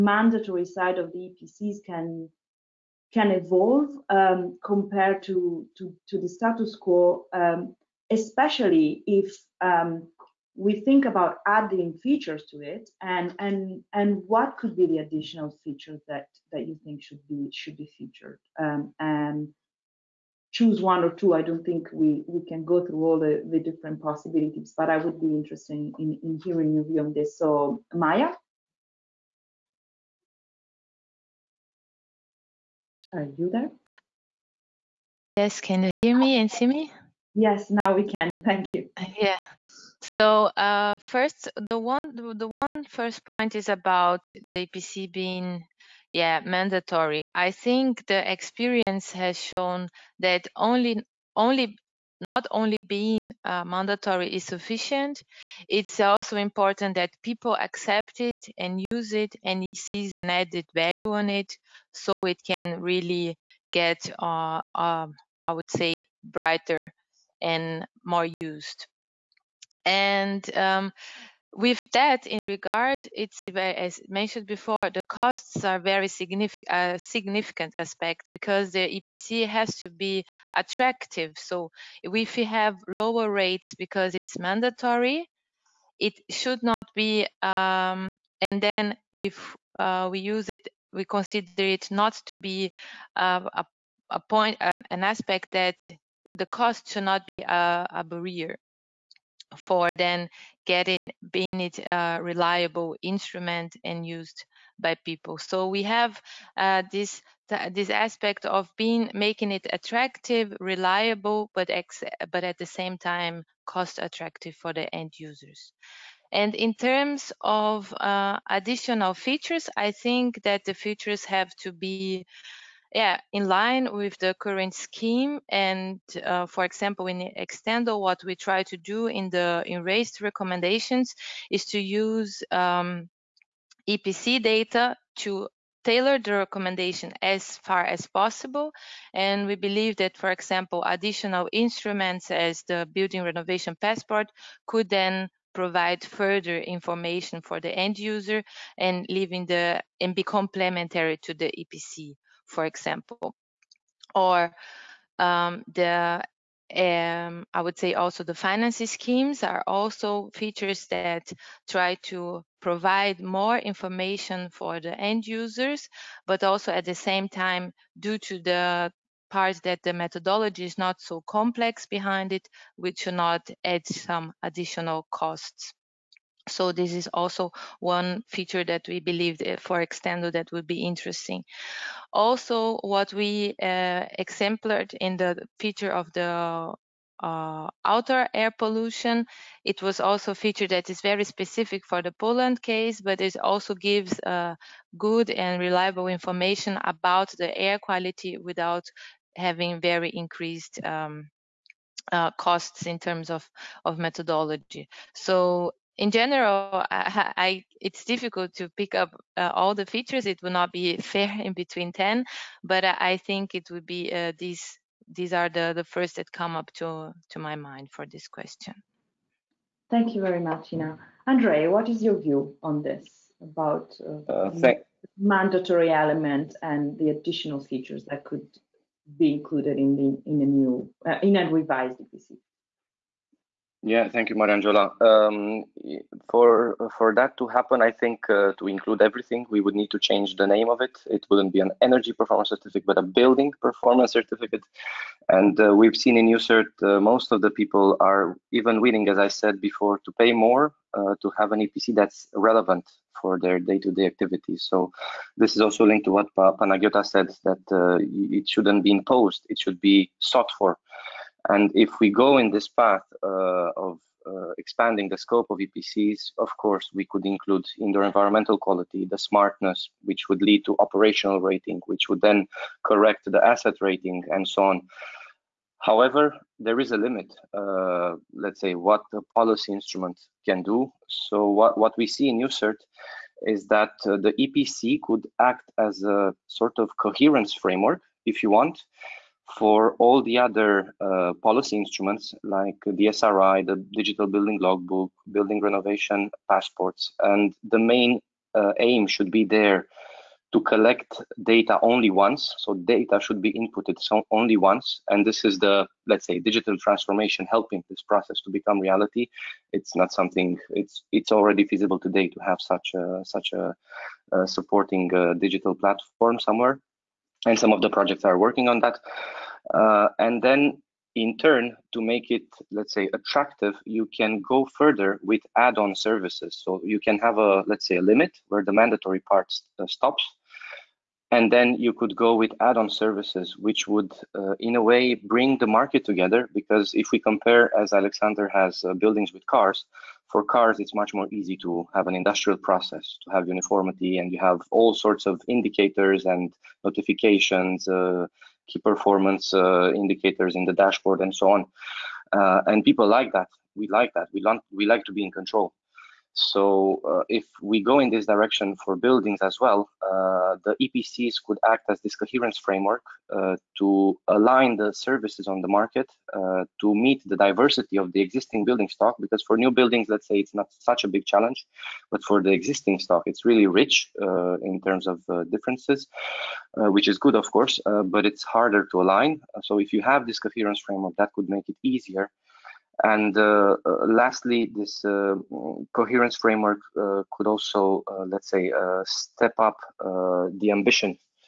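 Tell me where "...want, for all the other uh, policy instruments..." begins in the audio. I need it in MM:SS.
04:48.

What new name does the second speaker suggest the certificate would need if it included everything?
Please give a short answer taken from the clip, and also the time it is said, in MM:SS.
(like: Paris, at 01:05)
building performance certificate, at 04:03.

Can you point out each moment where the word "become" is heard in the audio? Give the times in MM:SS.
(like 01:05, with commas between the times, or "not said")
05:08.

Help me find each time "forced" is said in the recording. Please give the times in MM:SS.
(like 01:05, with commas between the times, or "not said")
not said.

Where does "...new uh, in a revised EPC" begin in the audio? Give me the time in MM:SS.
03:50.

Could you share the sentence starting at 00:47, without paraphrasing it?
I think the experience has shown that only, only, not only being uh, mandatory is sufficient.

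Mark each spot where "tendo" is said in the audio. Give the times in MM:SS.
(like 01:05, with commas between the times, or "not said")
02:07, 02:59.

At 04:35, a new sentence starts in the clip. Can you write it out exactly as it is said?
However, there is a limit, uh, let's say, what the policy instrument can do.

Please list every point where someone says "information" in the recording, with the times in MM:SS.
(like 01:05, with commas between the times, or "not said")
02:26, 02:43, 03:16.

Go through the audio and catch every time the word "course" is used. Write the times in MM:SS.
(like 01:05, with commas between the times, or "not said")
04:26, 06:17.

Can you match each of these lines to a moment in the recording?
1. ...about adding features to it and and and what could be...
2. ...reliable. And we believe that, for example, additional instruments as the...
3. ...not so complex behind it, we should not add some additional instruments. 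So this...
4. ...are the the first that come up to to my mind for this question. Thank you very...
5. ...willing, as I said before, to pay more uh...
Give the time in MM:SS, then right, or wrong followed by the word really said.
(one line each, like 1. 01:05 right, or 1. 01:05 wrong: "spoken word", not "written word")
1. 00:11 right
2. 02:18 wrong: "possible", not "reliable"
3. 02:50 wrong: "costs", not "instruments"
4. 03:35 right
5. 04:08 right.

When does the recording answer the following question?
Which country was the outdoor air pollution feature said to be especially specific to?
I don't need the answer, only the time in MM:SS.
03:12.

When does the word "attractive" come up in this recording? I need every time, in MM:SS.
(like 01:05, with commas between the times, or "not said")
01:20, 01:49, 01:54, 05:23.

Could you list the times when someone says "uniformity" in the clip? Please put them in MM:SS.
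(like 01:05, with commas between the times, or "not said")
05:43.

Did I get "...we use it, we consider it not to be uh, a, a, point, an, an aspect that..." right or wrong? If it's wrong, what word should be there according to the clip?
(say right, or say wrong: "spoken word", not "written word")
right.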